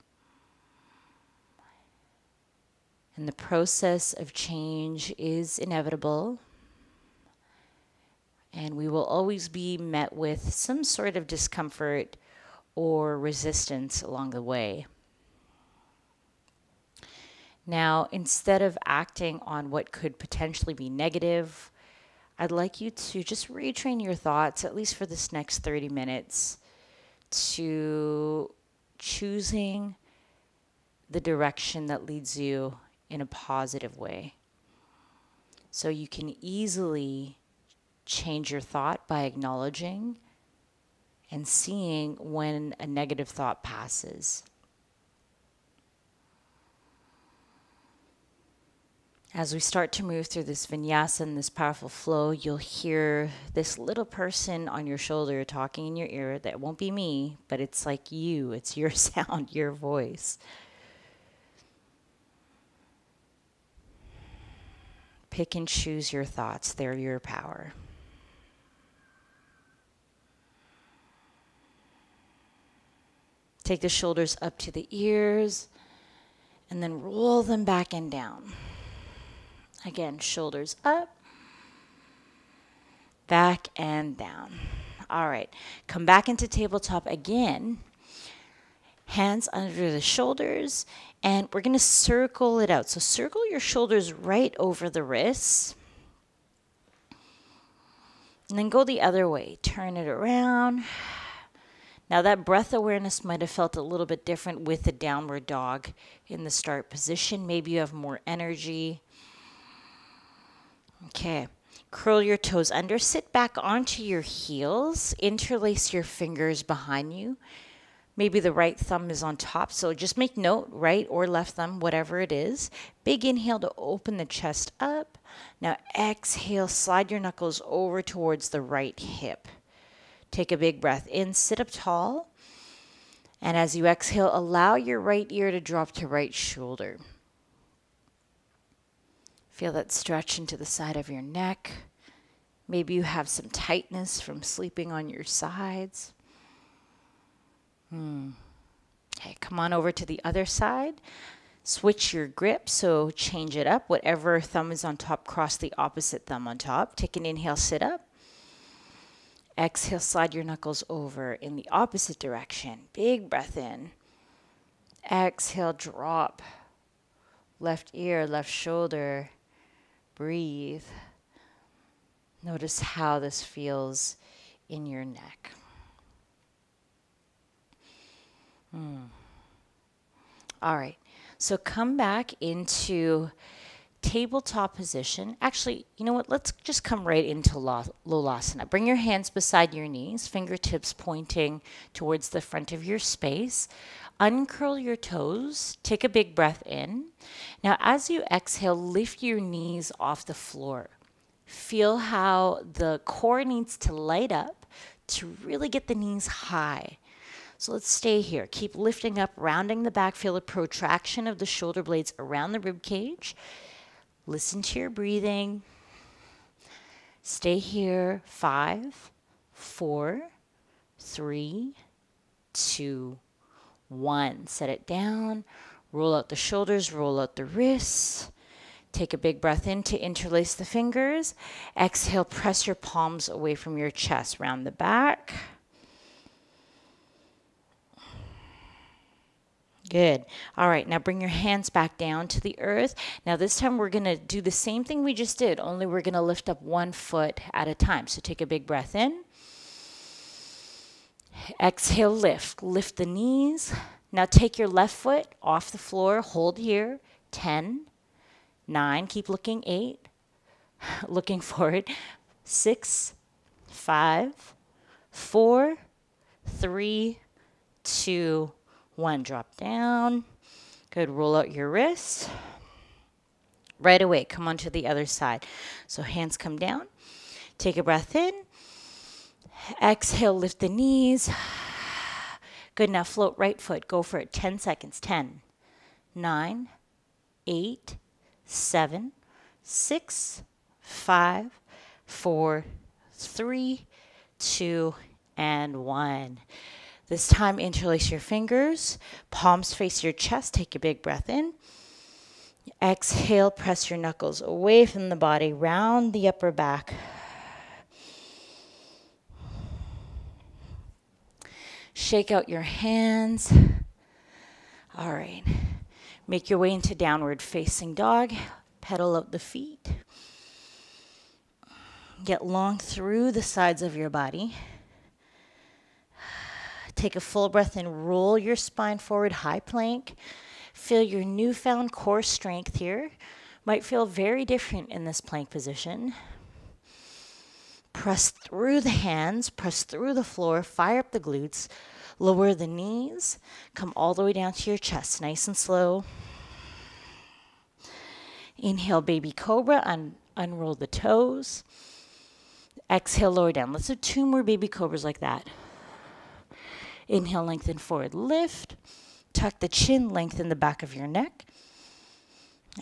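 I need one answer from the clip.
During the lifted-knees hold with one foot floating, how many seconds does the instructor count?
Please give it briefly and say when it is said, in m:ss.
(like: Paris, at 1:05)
10, at 4:44.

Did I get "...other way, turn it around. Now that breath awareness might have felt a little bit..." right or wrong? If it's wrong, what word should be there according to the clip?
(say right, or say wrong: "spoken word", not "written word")
right.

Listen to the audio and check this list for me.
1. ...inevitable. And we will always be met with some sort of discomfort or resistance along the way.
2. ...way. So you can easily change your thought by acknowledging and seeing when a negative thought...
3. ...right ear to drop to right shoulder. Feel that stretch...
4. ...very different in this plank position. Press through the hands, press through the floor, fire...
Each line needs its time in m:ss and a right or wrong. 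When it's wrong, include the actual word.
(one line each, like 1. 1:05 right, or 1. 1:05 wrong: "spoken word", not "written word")
1. 0:05 right
2. 0:33 right
3. 2:14 right
4. 5:34 right.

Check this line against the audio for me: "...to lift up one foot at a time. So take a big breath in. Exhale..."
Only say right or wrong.
right.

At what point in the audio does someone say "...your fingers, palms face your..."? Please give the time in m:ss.
4:58.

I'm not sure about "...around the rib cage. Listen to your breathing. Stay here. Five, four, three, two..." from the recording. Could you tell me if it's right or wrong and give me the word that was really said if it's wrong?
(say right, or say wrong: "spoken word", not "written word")
right.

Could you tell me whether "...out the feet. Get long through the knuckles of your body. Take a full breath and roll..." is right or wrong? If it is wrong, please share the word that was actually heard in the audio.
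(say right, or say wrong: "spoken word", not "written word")
wrong: "sides", not "knuckles".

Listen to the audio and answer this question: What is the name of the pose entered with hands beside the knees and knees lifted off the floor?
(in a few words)
Lolasana.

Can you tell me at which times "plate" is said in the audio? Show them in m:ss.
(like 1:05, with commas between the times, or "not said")
not said.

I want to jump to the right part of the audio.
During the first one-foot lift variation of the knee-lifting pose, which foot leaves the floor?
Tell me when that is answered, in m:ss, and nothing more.
4:14.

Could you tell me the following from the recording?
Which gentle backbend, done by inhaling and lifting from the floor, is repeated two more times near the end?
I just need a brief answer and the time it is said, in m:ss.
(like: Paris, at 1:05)
baby cobra, at 5:54.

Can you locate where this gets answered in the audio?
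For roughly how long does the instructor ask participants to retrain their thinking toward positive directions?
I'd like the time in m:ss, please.
0:25.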